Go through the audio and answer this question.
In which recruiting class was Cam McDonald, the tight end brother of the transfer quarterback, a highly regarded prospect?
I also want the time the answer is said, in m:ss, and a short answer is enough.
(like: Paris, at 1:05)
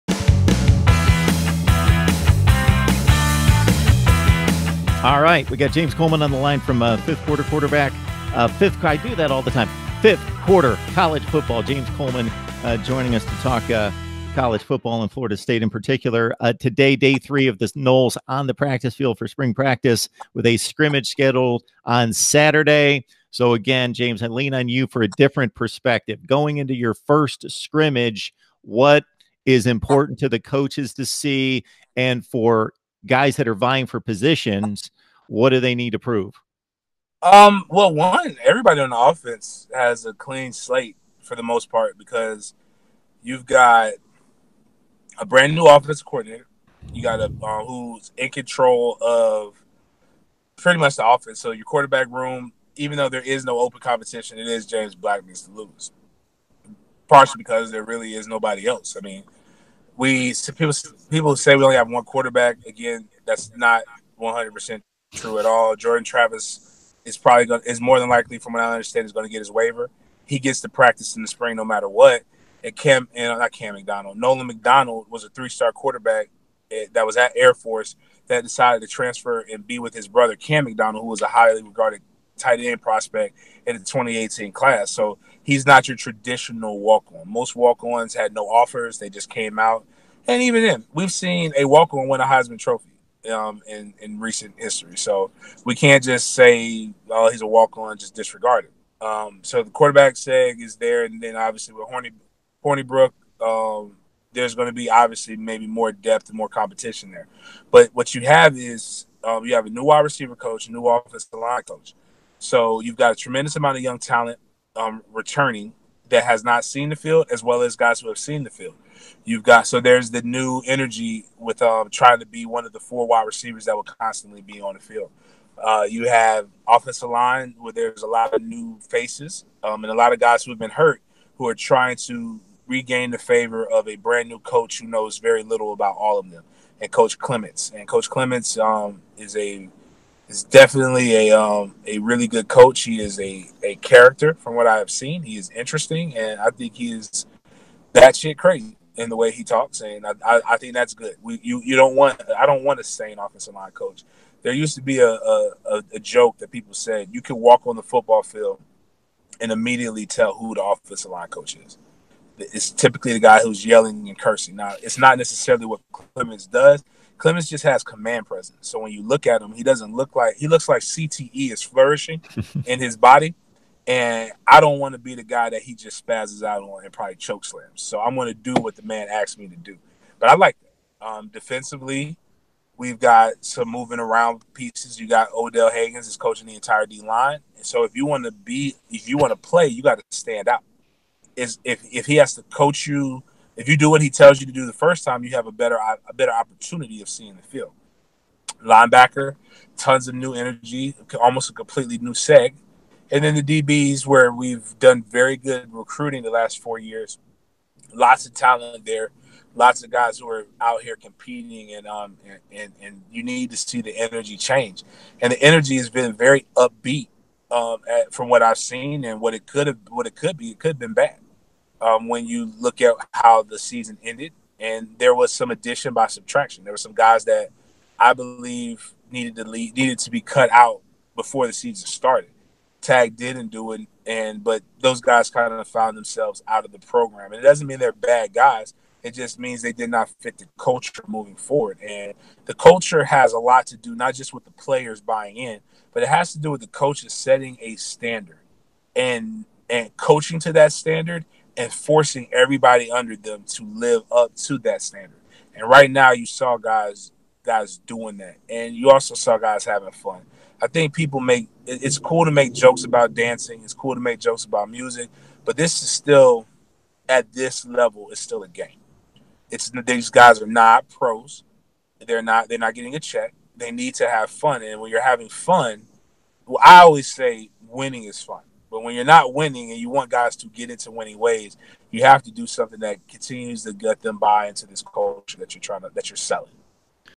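2018, at 1:23.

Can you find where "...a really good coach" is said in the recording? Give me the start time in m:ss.
2:21.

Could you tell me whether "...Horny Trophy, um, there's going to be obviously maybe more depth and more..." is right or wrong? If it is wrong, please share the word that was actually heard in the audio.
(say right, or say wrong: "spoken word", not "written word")
wrong: "Hornibrook", not "Trophy".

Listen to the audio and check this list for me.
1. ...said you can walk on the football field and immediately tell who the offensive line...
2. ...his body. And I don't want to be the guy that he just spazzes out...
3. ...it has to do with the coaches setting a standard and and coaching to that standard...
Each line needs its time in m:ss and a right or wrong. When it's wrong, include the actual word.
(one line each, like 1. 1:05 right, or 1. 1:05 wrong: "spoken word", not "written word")
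1. 2:36 right
2. 2:52 right
3. 4:06 right.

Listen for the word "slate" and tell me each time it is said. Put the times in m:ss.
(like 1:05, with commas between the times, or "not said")
0:40.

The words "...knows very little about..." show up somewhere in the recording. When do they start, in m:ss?
2:14.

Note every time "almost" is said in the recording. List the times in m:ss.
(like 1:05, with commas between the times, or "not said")
3:21.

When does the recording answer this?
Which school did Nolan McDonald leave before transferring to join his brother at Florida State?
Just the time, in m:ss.
1:17.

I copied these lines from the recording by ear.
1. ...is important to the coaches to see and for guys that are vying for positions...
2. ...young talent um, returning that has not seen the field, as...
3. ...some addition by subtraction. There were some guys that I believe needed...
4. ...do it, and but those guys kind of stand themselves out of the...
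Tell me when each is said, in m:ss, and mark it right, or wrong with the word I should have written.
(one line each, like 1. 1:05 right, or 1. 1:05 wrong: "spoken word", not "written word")
1. 0:29 right
2. 1:53 right
3. 3:45 right
4. 3:53 wrong: "found", not "stand".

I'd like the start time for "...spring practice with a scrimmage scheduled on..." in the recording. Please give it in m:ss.
0:19.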